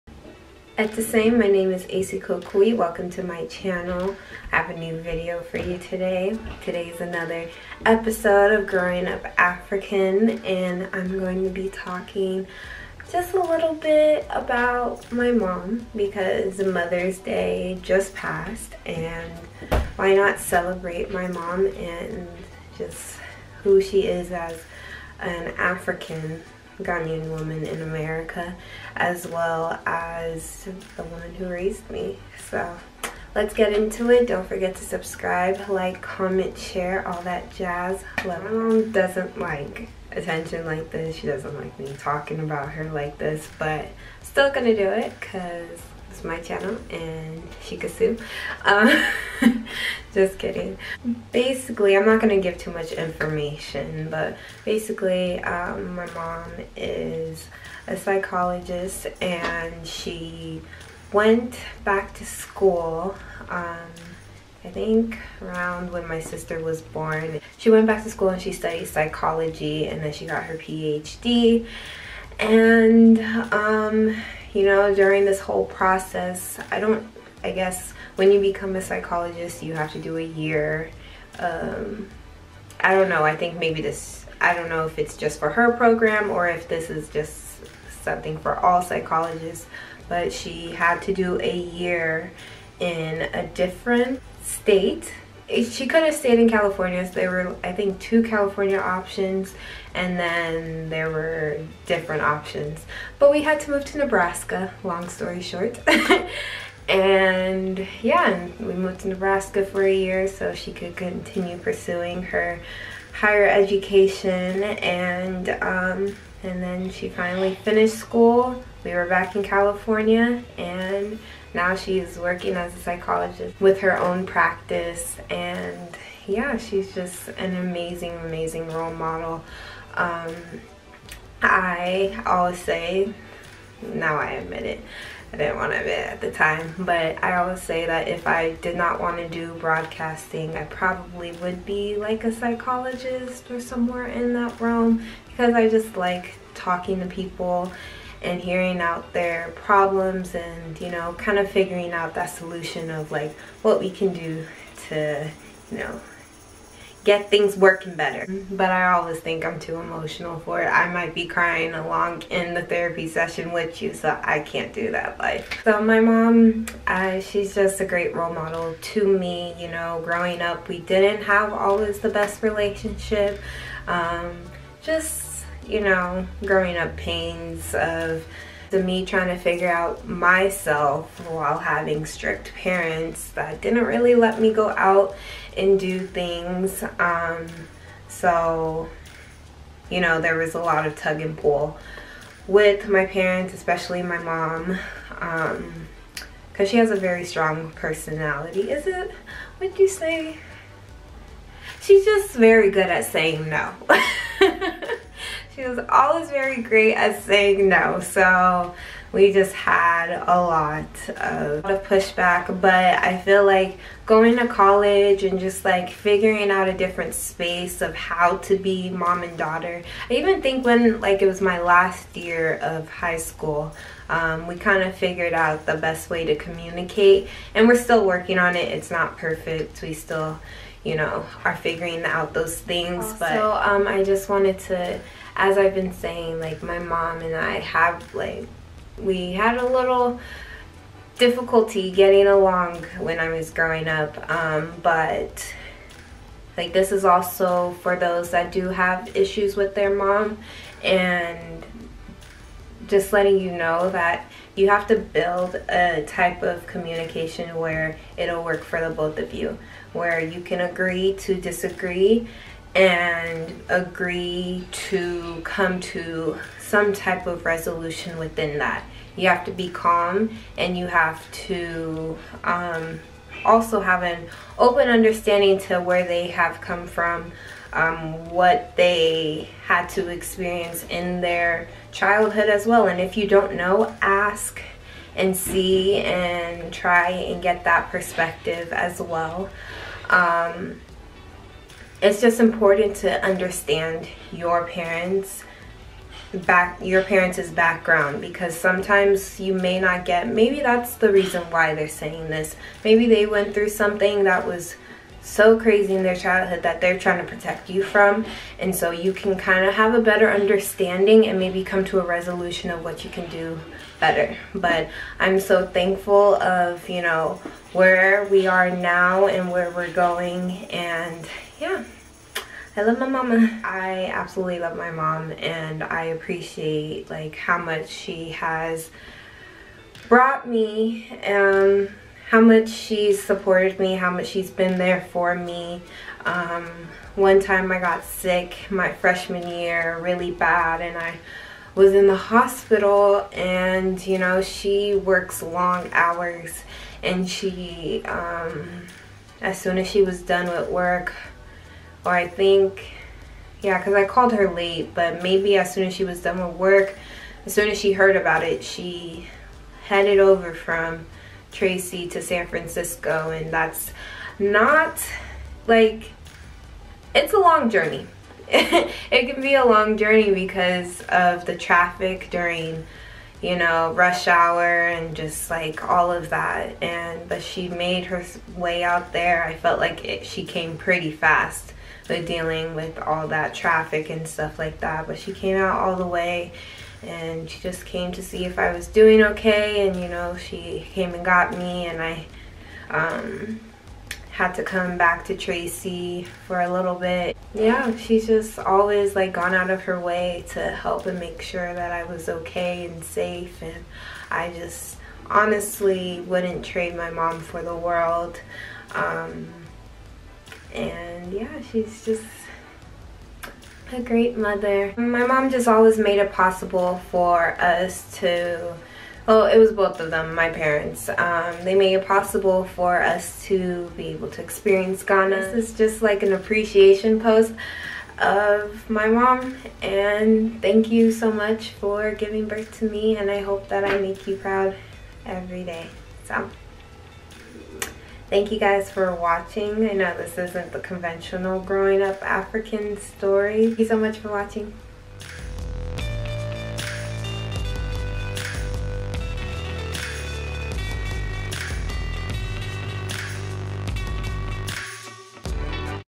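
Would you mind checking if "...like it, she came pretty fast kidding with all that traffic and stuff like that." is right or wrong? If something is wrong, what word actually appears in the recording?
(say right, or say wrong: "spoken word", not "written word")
wrong: "dealing", not "kidding".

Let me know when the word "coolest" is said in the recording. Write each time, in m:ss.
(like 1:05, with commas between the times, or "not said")
not said.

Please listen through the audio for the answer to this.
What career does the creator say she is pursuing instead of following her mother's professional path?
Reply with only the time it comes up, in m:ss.
2:19.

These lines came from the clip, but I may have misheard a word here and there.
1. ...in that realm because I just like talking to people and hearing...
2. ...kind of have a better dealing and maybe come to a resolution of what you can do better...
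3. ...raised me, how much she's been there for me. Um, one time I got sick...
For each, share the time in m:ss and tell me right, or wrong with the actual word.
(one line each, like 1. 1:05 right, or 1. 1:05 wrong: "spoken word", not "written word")
1. 2:24 right
2. 5:09 wrong: "understanding", not "dealing"
3. 5:33 wrong: "supported", not "raised".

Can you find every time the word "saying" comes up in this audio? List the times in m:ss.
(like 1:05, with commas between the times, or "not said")
3:23, 3:27, 3:55, 5:01.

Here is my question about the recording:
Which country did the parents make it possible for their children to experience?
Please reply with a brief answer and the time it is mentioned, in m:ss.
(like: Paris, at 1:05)
Ghana, at 7:05.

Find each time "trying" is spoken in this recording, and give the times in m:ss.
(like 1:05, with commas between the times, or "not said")
2:59, 5:06.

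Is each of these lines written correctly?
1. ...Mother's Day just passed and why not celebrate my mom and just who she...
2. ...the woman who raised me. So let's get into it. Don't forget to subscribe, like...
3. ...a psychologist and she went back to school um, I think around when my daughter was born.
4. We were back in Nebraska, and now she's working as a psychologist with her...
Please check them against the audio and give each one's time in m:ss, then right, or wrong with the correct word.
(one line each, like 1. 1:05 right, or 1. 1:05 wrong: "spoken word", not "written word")
1. 0:16 right
2. 0:30 right
3. 0:57 wrong: "sister", not "daughter"
4. 1:58 wrong: "California", not "Nebraska".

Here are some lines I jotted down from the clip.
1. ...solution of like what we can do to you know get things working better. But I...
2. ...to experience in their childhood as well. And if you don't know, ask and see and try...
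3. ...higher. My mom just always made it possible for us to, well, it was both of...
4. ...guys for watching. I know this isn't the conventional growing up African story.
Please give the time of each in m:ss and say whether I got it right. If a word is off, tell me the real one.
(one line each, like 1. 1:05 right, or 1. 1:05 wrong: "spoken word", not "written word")
1. 2:32 right
2. 4:39 right
3. 6:54 wrong: "mother", not "higher"
4. 7:18 right.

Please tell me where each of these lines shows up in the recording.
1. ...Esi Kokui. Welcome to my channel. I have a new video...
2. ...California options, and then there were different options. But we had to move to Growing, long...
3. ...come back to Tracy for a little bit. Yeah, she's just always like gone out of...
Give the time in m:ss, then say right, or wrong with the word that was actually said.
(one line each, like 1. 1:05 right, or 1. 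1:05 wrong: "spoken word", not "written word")
1. 0:01 right
2. 1:38 wrong: "Nebraska", not "Growing"
3. 6:34 right.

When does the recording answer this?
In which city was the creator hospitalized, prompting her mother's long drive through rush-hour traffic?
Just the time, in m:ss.
6:02.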